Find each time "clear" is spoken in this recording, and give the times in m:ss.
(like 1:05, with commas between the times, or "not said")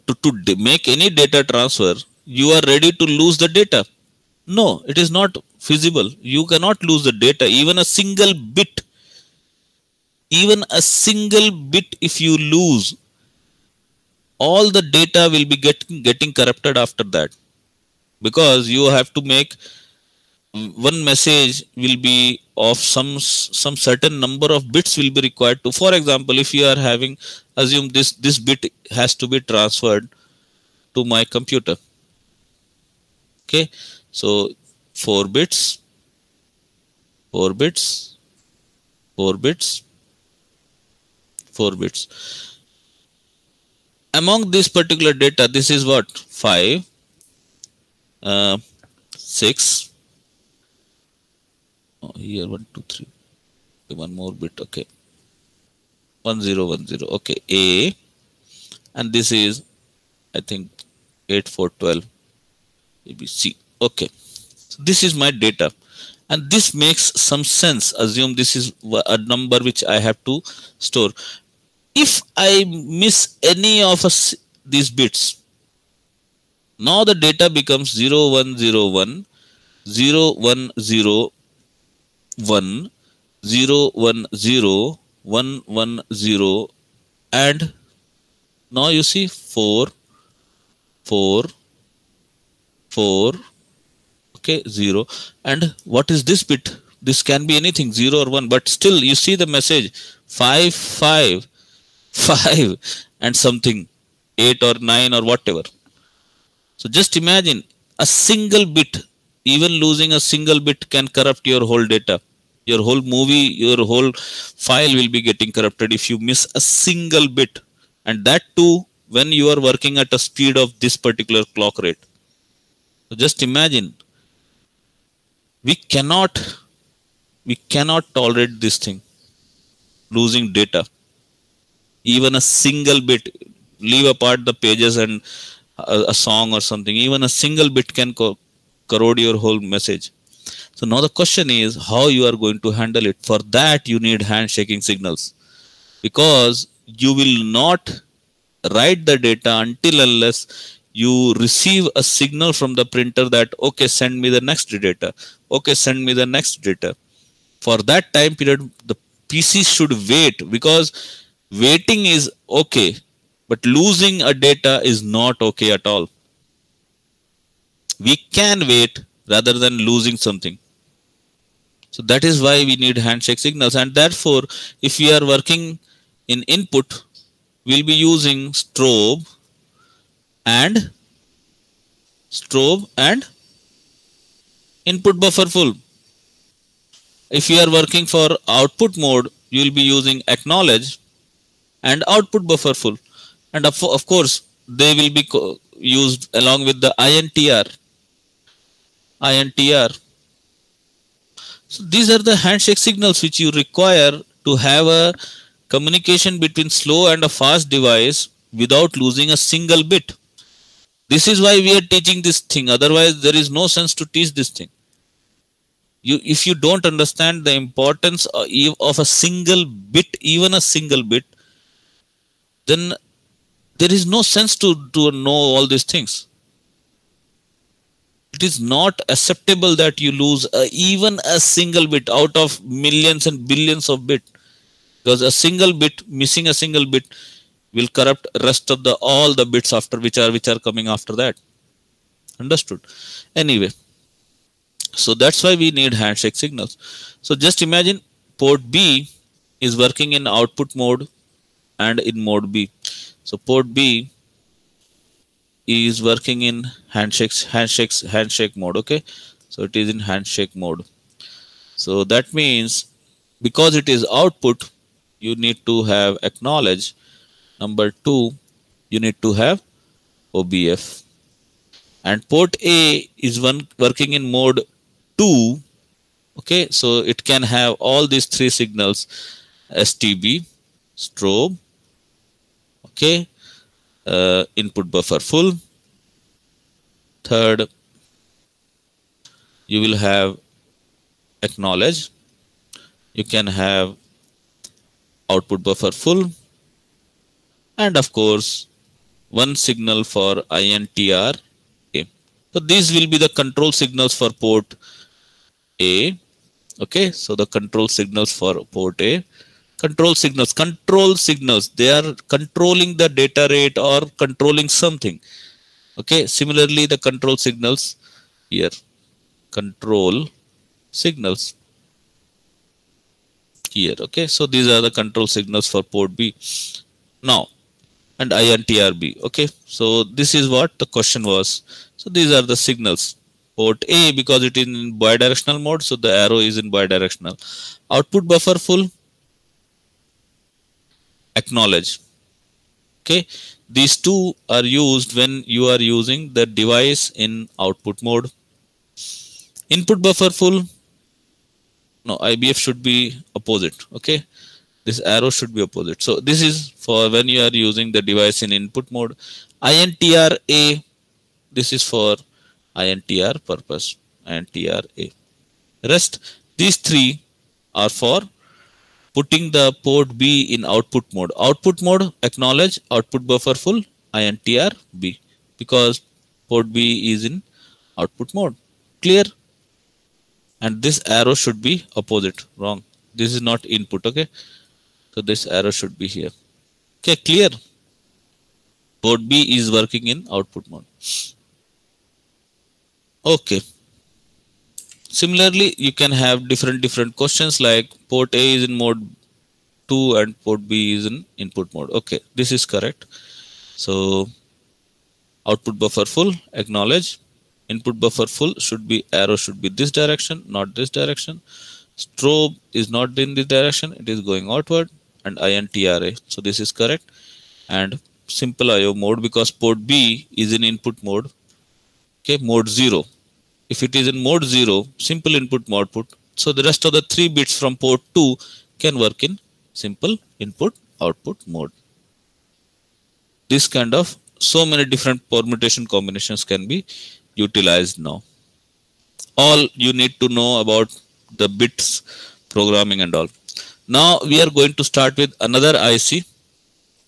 6:19, 6:27.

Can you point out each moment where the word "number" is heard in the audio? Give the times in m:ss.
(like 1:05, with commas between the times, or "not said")
0:24, 1:09, 4:27.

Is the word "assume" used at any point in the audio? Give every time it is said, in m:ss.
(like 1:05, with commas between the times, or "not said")
0:27, 1:08.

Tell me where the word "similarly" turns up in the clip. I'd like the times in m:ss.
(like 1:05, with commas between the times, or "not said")
5:16, 6:35.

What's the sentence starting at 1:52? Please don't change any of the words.
Your whole movie, your whole file will be getting corrupted if you miss a single bit.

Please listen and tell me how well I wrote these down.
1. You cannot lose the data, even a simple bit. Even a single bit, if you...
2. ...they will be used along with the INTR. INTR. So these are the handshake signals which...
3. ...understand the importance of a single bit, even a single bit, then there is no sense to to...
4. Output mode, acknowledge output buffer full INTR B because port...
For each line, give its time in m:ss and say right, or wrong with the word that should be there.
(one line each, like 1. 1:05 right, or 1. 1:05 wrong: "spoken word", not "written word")
1. 0:06 wrong: "single", not "simple"
2. 3:14 right
3. 3:36 right
4. 6:11 right.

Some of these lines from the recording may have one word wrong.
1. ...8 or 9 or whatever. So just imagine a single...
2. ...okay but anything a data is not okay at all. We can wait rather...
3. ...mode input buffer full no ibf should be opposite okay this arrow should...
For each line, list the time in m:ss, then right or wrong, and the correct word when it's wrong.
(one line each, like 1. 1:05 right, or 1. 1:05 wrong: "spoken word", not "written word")
1. 1:44 right
2. 2:42 wrong: "losing", not "anything"
3. 5:48 right.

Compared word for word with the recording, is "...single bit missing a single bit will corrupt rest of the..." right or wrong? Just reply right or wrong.
right.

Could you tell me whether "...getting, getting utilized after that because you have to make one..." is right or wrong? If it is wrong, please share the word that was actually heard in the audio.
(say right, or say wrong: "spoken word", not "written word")
wrong: "corrupted", not "utilized".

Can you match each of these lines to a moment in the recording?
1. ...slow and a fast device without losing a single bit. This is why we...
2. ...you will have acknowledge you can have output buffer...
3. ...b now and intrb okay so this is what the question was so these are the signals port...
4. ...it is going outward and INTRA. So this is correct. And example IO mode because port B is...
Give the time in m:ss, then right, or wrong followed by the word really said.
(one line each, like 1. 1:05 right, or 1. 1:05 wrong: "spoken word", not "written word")
1. 3:26 right
2. 4:49 right
3. 5:26 right
4. 6:54 wrong: "simple", not "example".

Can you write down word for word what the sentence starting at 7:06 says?
So the rest of the three bits from port 2 can work in simple input output mode.